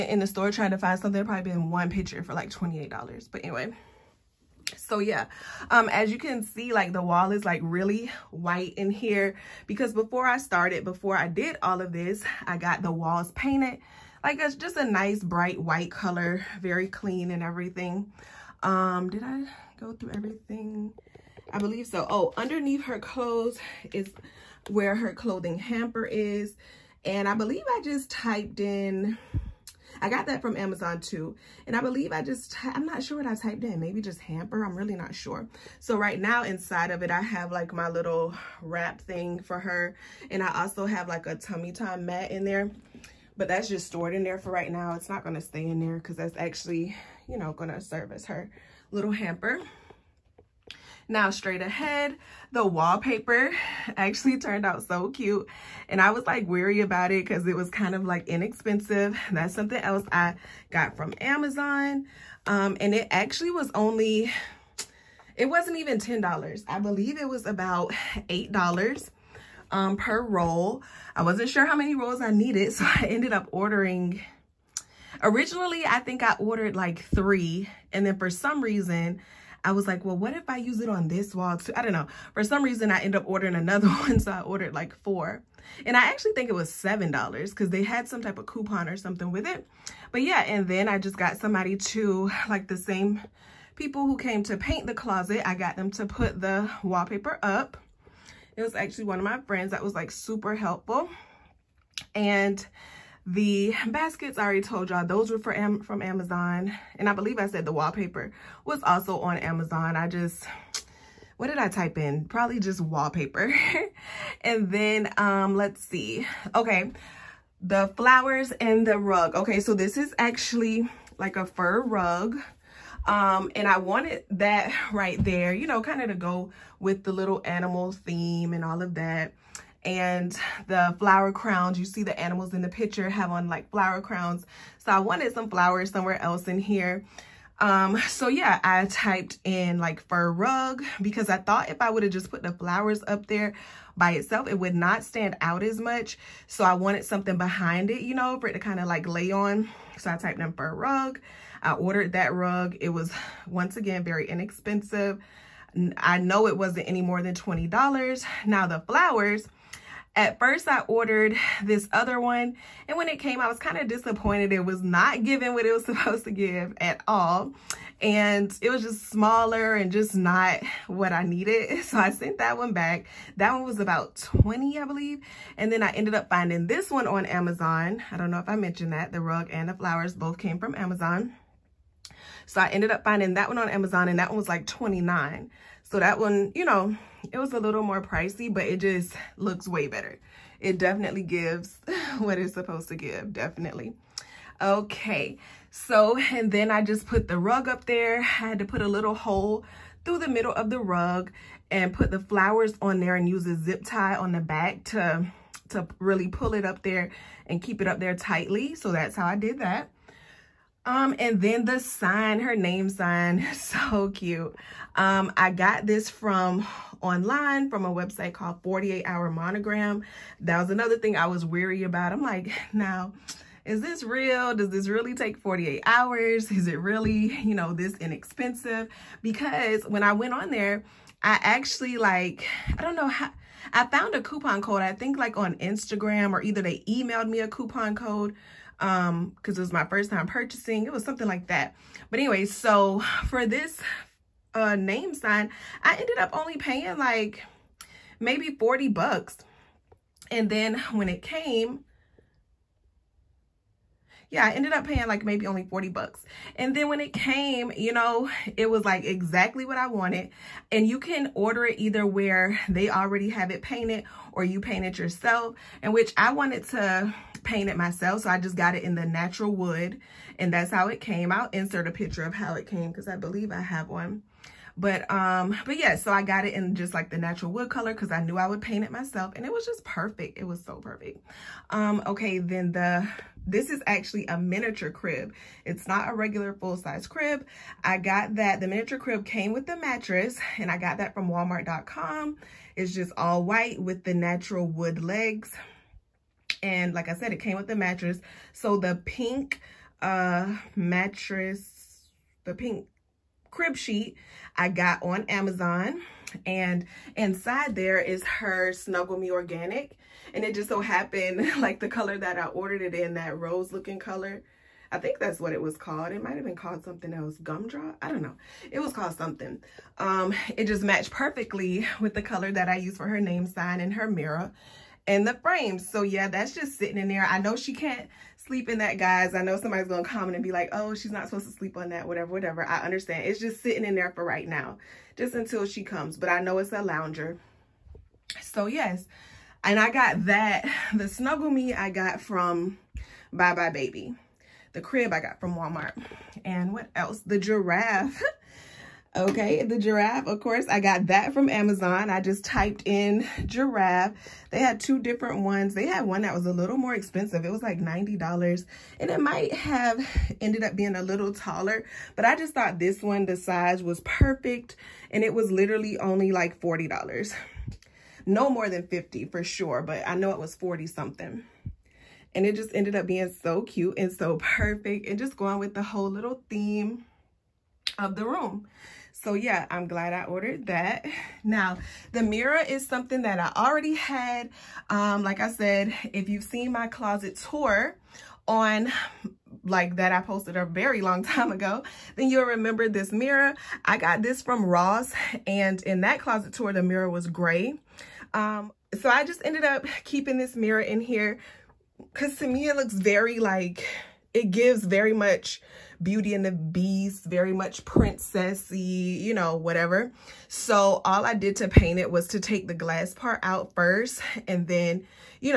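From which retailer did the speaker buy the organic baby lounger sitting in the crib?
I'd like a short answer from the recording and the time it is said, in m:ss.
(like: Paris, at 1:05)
buybuy BABY, at 5:43.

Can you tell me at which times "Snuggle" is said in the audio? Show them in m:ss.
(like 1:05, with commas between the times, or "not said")
5:08, 5:41.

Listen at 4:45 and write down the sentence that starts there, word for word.
It's not a regular full size crib.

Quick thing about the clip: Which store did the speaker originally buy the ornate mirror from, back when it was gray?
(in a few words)
Ross.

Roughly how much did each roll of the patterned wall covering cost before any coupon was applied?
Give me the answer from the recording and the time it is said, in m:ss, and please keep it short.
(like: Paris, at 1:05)
$8, at 1:08.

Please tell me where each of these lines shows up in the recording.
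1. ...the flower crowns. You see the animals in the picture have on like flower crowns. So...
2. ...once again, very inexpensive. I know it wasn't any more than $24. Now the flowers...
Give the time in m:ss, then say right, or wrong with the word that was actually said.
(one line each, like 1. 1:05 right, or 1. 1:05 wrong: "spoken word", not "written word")
1. 2:10 right
2. 2:33 wrong: "20", not "24".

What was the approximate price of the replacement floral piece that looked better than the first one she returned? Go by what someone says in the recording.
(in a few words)
29.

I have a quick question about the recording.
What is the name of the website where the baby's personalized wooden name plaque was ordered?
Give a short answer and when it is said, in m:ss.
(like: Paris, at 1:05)
48 Hour Monogram, at 3:38.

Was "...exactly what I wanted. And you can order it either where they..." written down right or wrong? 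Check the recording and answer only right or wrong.
right.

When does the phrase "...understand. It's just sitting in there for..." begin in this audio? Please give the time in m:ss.
5:32.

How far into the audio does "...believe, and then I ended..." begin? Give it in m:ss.
2:54.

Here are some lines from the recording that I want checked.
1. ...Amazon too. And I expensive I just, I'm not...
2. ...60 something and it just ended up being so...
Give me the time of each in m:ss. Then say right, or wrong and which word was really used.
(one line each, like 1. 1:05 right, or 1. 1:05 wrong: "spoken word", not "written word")
1. 0:30 wrong: "believe", not "expensive"
2. 6:10 wrong: "40", not "60".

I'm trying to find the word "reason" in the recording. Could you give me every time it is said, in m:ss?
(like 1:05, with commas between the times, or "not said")
1:18, 1:22.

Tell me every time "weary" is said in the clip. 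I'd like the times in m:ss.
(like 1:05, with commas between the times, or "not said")
0:56, 3:41.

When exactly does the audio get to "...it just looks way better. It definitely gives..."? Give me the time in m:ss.
3:08.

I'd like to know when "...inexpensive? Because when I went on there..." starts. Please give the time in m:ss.
3:47.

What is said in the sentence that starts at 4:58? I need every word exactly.
So the pink uh, mattress, the pink crib sheet I got on Amazon.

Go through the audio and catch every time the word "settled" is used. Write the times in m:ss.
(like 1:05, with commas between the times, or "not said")
not said.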